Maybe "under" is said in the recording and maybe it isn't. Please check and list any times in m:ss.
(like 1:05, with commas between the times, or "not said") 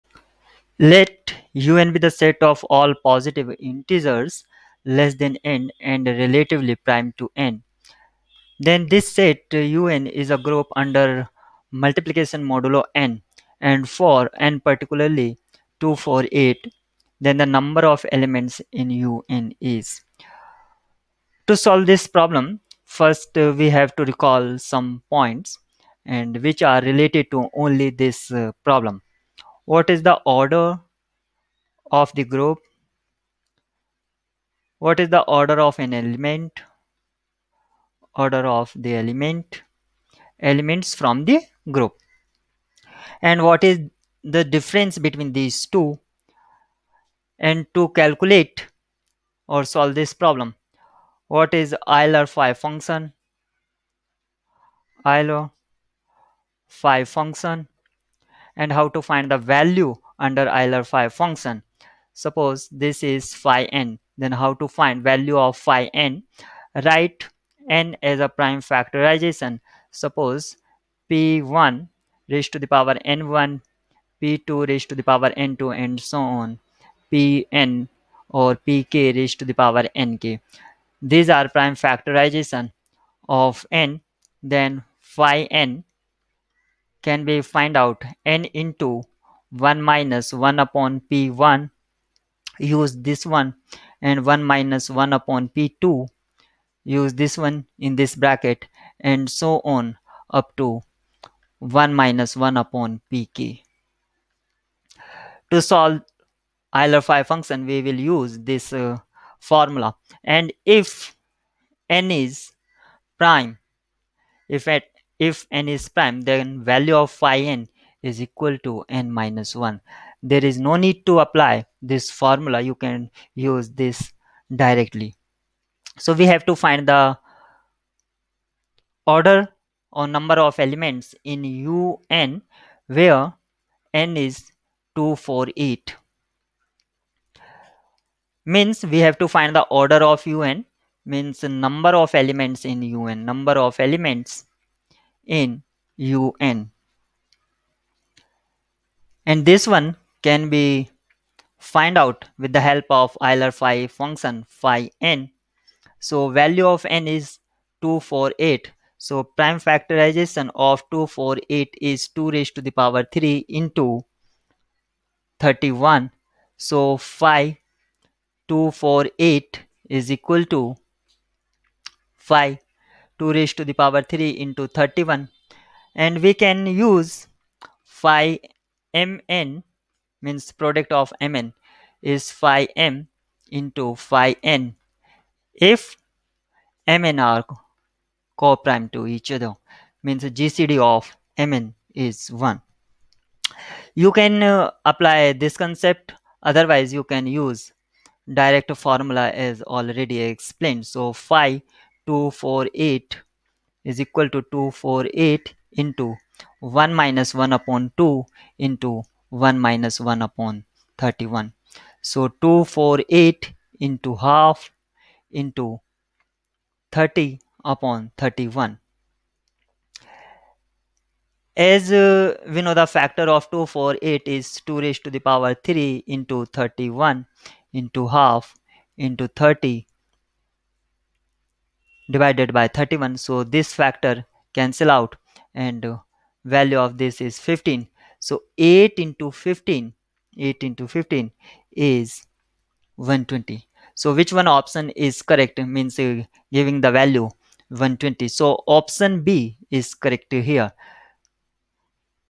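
0:10, 1:00.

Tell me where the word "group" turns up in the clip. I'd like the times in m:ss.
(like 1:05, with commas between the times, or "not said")
0:10, 0:32, 0:41.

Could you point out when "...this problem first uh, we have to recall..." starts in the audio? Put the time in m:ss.
0:21.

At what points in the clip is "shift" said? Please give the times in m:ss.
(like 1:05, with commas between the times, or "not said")
not said.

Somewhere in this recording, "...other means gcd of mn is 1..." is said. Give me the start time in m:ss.
3:09.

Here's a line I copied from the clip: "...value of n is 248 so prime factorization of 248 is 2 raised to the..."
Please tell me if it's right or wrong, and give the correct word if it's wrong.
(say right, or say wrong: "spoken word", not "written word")
right.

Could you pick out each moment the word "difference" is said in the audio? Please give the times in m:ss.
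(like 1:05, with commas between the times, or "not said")
0:44.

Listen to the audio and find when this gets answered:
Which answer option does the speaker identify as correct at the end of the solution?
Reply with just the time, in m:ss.
4:08.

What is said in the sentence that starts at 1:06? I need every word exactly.
Write n as a prime factorization.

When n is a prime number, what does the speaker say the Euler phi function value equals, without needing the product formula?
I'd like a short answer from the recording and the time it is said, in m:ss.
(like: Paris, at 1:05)
n minus 1, at 1:59.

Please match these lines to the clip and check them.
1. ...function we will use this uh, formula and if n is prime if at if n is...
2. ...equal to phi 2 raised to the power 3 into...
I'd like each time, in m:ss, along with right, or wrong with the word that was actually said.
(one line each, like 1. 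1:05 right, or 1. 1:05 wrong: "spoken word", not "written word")
1. 1:47 right
2. 2:50 right.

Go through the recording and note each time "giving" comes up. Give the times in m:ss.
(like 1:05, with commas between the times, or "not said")
4:06.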